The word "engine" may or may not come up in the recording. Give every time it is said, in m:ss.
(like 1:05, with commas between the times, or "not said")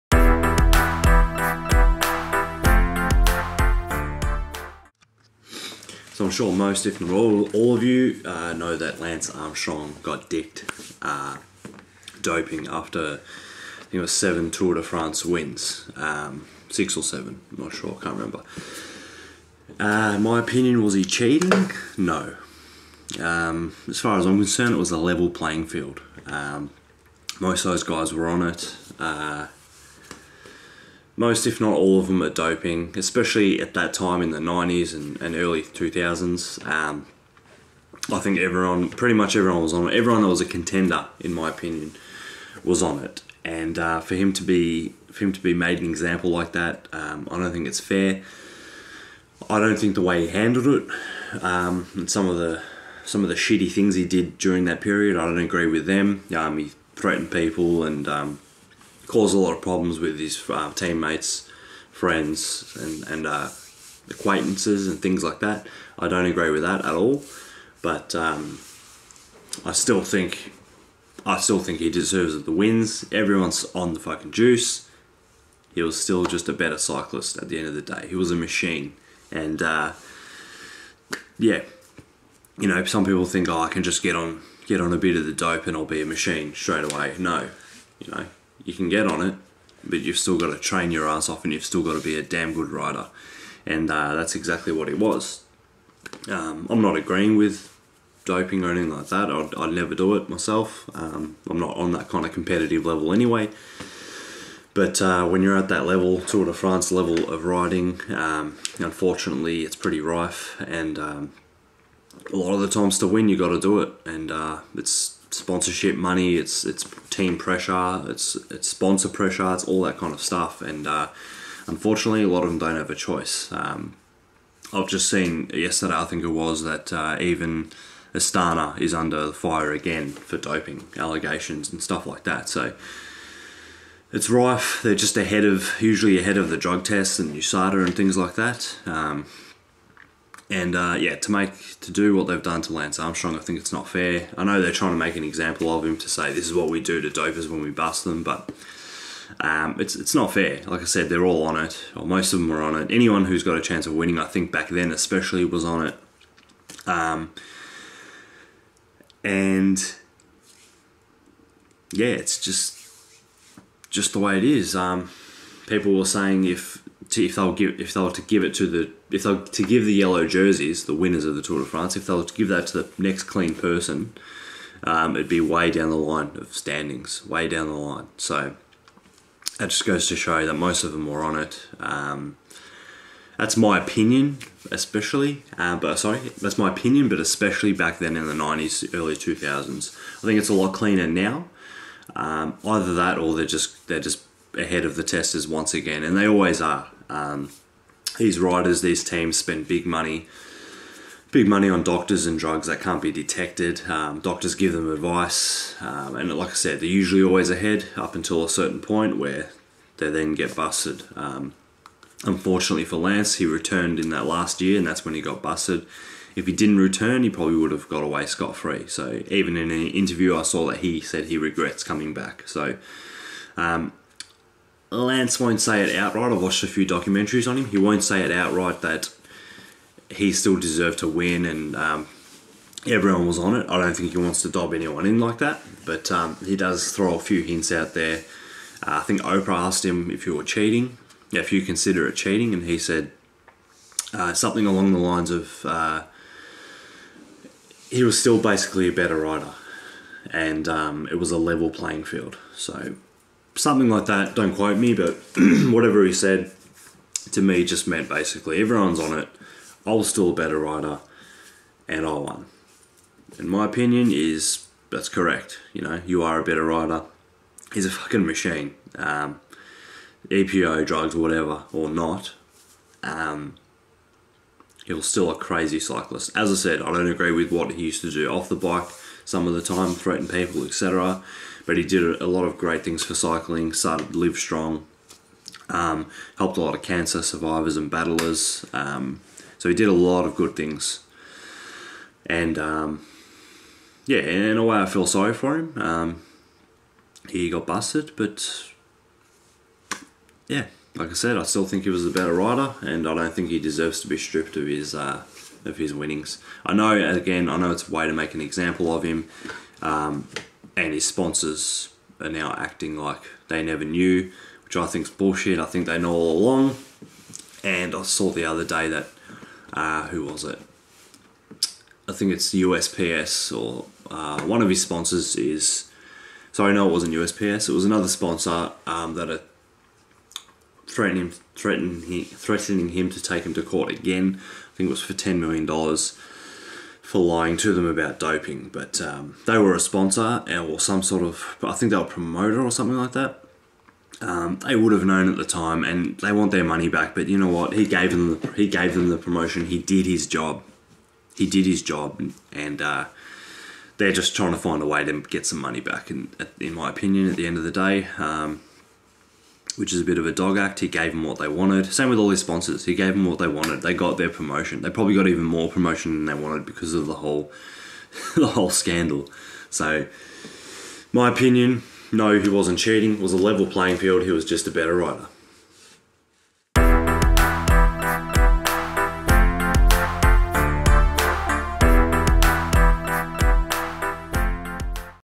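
not said.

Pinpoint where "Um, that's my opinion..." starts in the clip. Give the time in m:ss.
3:01.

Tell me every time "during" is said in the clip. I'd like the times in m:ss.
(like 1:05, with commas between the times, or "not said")
0:54.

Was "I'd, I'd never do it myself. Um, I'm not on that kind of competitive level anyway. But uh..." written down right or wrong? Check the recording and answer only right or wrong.
right.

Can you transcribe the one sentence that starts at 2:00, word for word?
And uh, unfortunately, a lot of them don't have a choice.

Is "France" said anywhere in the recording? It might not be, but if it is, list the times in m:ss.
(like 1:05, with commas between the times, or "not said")
0:14, 1:46, 2:51.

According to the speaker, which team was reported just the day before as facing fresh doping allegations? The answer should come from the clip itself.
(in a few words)
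Astana.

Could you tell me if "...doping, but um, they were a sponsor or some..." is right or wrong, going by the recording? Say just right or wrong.
right.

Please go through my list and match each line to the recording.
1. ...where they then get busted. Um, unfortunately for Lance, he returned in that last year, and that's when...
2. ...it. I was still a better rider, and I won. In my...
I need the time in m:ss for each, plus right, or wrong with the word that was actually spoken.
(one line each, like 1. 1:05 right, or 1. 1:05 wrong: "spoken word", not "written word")
1. 3:29 right
2. 4:19 right.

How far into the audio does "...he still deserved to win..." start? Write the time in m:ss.
3:50.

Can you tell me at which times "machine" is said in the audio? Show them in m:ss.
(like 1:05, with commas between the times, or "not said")
1:18, 1:26, 4:28.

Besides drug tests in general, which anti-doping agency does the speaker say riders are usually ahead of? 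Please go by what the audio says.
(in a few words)
USADA.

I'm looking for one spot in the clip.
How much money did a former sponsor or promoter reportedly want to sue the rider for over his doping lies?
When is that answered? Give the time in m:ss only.
5:35.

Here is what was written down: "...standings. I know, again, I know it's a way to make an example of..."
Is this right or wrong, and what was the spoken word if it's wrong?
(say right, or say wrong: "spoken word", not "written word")
wrong: "winnings", not "standings".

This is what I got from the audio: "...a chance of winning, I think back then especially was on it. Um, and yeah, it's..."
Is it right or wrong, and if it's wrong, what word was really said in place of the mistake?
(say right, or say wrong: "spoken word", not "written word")
right.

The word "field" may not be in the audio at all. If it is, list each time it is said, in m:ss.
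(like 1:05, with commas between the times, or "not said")
0:25, 4:12, 6:13.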